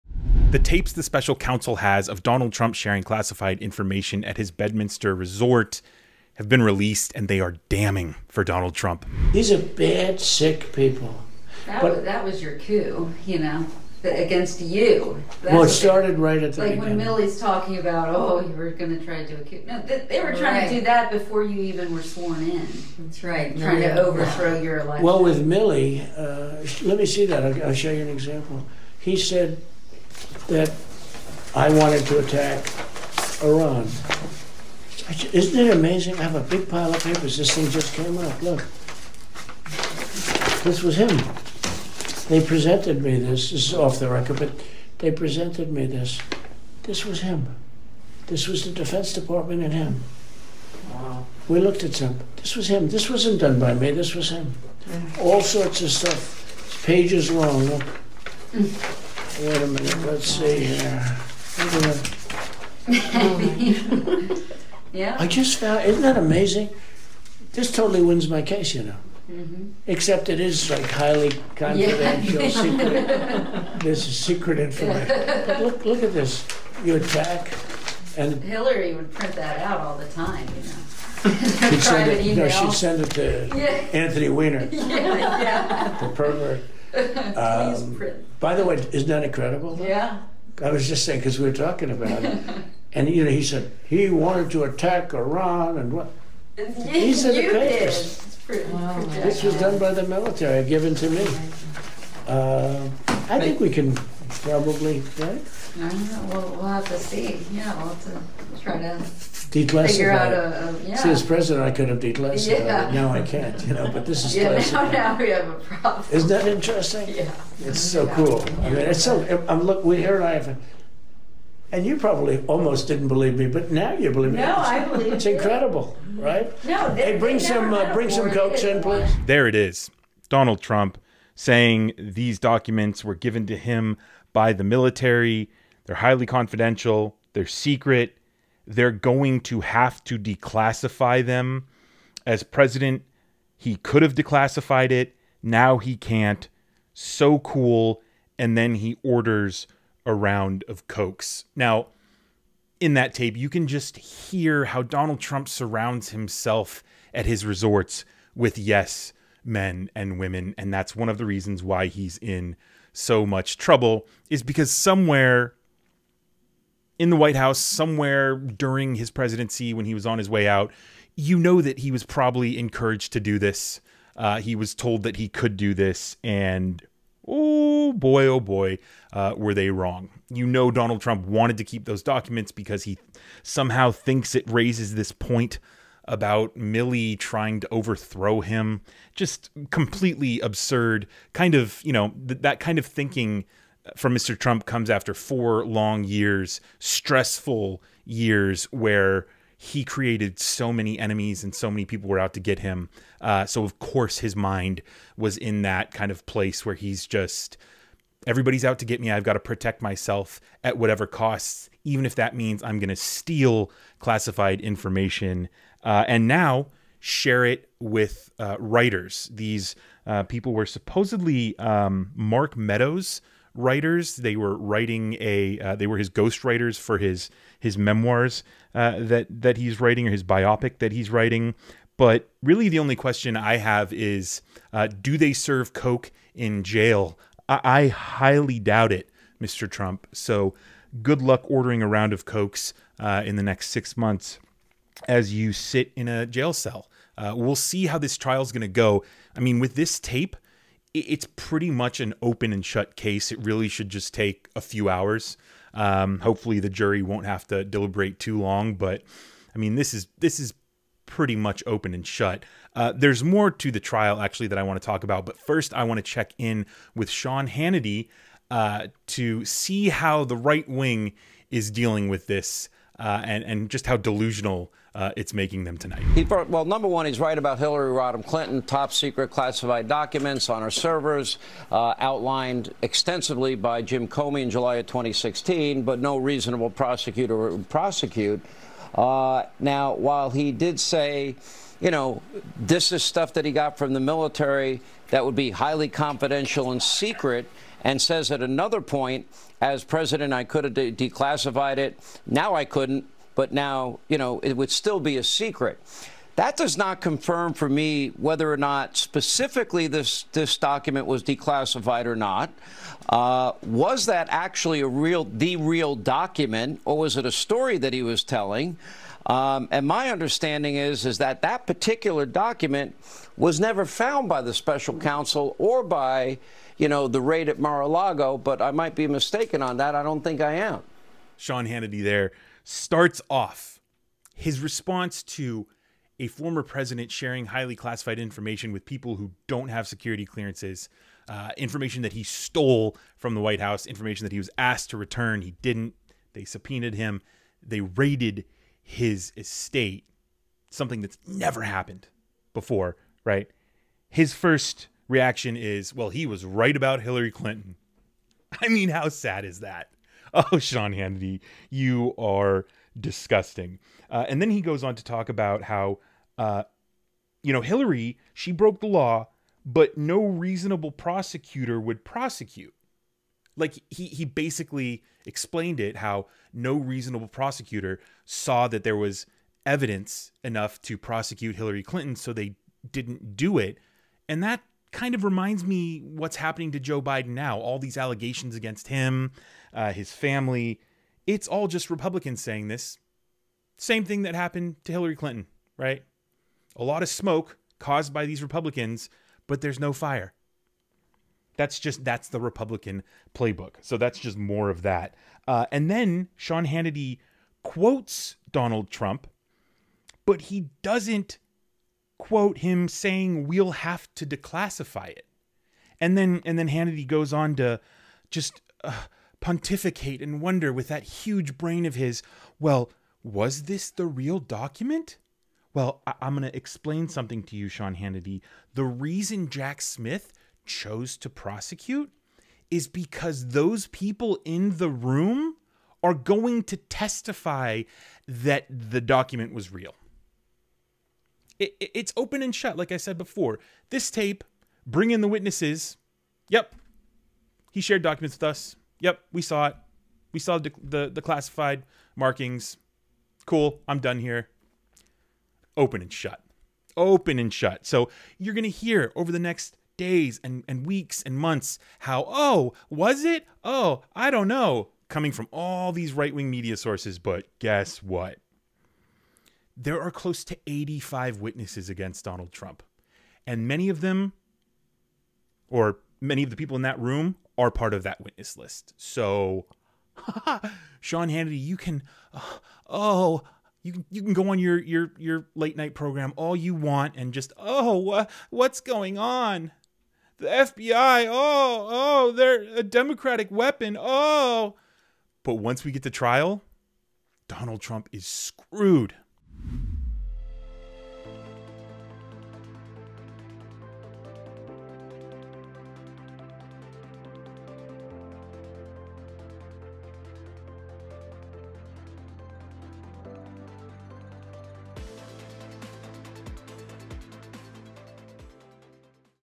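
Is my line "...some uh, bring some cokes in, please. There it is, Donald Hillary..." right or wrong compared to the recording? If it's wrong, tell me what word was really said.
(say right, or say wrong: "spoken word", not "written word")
wrong: "Trump", not "Hillary".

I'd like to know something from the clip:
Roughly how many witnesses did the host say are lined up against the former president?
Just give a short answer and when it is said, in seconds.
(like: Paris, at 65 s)
85, at 470 s.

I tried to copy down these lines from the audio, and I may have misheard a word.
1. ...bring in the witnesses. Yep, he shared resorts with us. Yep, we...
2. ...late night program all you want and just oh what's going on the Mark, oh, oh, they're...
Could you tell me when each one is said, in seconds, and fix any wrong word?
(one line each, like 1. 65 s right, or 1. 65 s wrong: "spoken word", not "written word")
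1. 444 s wrong: "documents", not "resorts"
2. 485 s wrong: "FBI", not "Mark".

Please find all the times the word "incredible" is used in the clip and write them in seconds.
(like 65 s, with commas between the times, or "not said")
89 s, 125 s.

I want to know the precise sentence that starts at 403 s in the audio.
So that's just more of that.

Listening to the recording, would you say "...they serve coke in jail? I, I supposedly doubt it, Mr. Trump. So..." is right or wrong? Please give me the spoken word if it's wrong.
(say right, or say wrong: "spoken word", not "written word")
wrong: "highly", not "supposedly".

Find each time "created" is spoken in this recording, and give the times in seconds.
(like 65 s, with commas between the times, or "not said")
199 s.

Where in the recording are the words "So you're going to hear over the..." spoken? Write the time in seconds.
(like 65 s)
457 s.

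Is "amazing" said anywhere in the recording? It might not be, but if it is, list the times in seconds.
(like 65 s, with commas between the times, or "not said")
35 s, 66 s.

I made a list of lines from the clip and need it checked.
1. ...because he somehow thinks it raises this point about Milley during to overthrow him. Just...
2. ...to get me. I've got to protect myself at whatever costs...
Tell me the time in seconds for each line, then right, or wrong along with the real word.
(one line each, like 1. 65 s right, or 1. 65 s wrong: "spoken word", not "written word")
1. 182 s wrong: "trying", not "during"
2. 208 s right.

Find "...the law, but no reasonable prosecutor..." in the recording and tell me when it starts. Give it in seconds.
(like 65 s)
368 s.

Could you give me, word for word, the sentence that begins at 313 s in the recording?
Uh, was that actually a real, the real document, or was it a story that he was telling?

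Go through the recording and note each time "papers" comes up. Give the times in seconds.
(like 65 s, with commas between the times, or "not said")
37 s, 97 s.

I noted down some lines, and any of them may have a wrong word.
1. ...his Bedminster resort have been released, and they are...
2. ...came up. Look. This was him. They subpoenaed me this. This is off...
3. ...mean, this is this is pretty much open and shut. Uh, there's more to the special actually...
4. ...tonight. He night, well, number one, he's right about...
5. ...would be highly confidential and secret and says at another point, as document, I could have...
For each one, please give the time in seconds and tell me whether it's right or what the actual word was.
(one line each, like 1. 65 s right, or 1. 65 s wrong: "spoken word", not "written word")
1. 4 s right
2. 37 s wrong: "presented", not "subpoenaed"
3. 259 s wrong: "trial", not "special"
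4. 275 s wrong: "brought", not "night"
5. 295 s wrong: "president", not "document".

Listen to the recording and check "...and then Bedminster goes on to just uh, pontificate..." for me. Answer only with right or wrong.
wrong.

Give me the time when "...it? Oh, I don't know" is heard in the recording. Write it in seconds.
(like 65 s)
463 s.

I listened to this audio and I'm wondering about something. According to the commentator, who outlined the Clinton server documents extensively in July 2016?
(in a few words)
Jim Comey.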